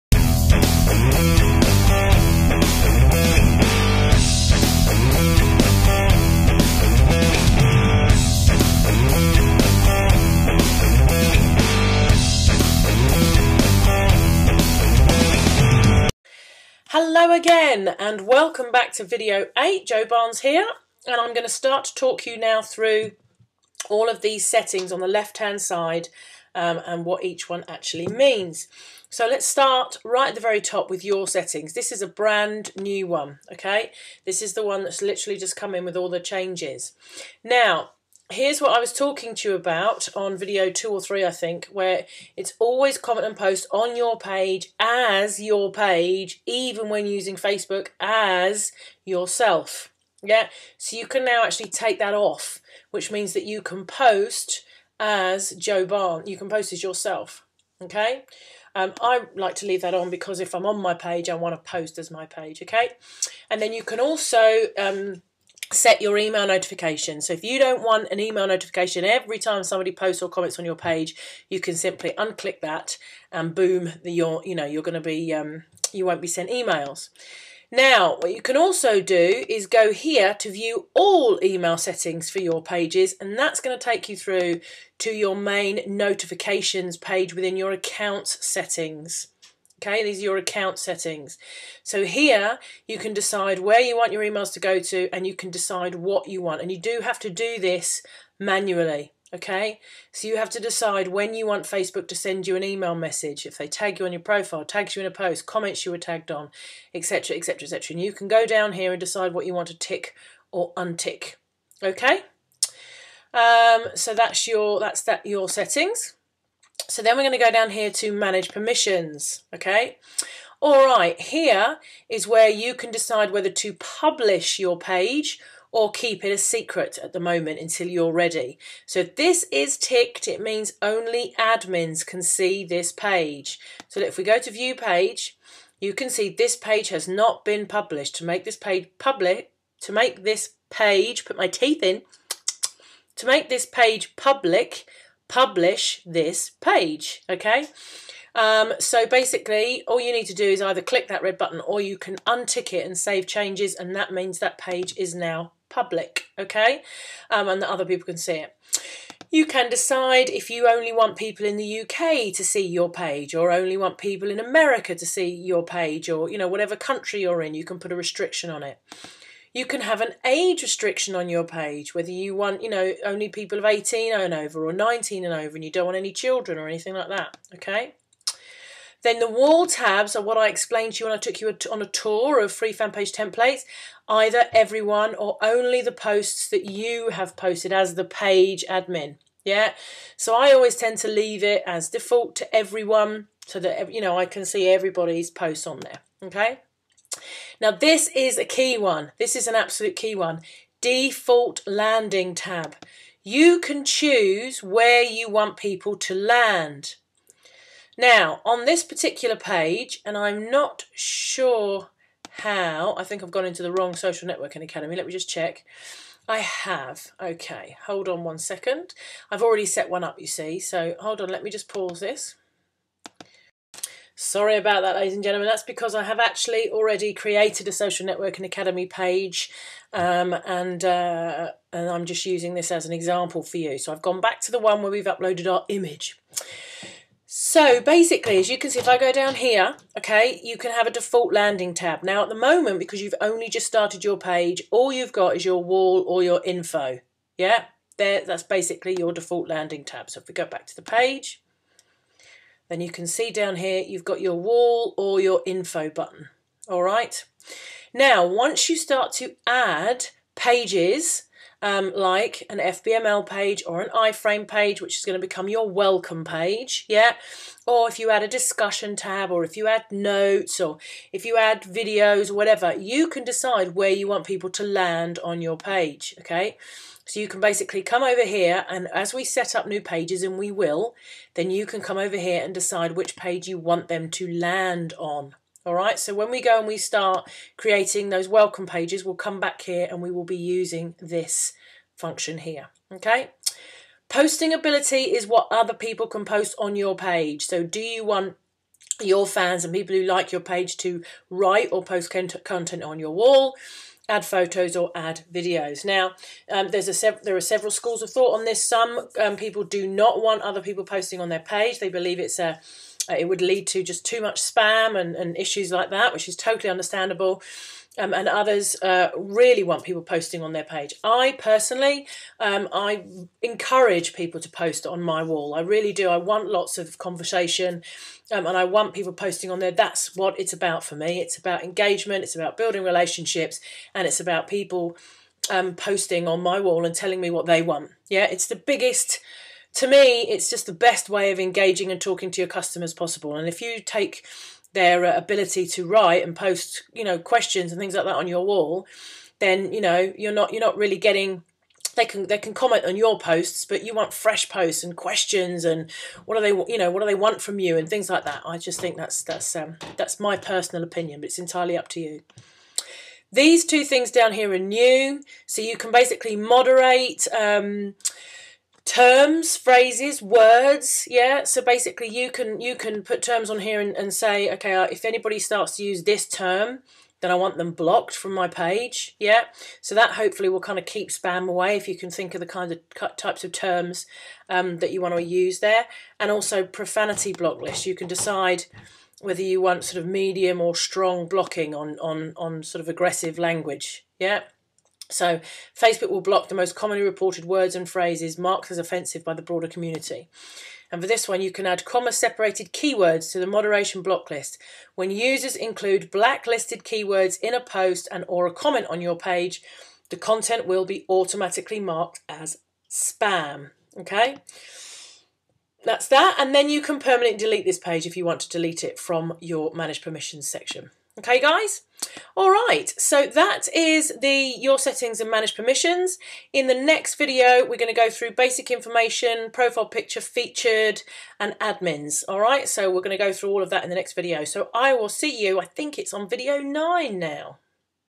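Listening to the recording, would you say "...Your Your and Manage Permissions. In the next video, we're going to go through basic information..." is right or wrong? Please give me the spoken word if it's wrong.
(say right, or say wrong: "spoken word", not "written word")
wrong: "Settings", not "Your".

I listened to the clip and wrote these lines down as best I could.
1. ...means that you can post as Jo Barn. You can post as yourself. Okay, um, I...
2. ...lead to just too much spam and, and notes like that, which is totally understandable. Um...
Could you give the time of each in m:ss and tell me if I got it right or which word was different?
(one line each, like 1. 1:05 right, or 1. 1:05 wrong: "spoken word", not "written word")
1. 0:53 right
2. 5:13 wrong: "issues", not "notes".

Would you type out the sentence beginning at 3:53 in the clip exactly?
So I've gone back to the one where we've uploaded our image.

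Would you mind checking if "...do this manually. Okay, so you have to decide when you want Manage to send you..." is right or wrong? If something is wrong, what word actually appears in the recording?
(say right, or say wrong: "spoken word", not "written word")
wrong: "Facebook", not "Manage".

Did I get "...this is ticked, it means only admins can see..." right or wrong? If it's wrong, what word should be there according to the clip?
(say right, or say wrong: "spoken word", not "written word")
right.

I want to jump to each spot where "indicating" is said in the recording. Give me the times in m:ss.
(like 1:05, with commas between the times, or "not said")
not said.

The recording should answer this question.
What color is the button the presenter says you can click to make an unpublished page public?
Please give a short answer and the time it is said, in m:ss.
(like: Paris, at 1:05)
red, at 2:31.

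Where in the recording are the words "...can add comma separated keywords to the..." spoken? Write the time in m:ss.
6:41.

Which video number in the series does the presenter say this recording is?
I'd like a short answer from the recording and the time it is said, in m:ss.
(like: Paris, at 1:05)
8, at 0:19.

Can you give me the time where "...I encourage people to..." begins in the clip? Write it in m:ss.
5:22.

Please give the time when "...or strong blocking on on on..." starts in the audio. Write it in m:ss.
6:30.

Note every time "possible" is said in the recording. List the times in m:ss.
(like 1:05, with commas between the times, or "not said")
5:42.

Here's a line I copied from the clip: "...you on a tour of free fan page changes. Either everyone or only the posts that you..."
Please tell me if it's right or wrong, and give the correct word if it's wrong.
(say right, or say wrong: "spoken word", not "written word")
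wrong: "templates", not "changes".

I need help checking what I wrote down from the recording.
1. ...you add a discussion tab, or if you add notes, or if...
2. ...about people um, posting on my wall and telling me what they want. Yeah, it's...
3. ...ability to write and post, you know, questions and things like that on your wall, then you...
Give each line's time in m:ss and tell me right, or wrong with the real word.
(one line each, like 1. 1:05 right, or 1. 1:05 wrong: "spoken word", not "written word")
1. 4:27 right
2. 5:34 right
3. 5:45 right.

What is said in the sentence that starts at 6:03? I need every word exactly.
These two things down here are new, so you can basically moderate.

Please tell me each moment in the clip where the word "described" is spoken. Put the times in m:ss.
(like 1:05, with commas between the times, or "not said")
not said.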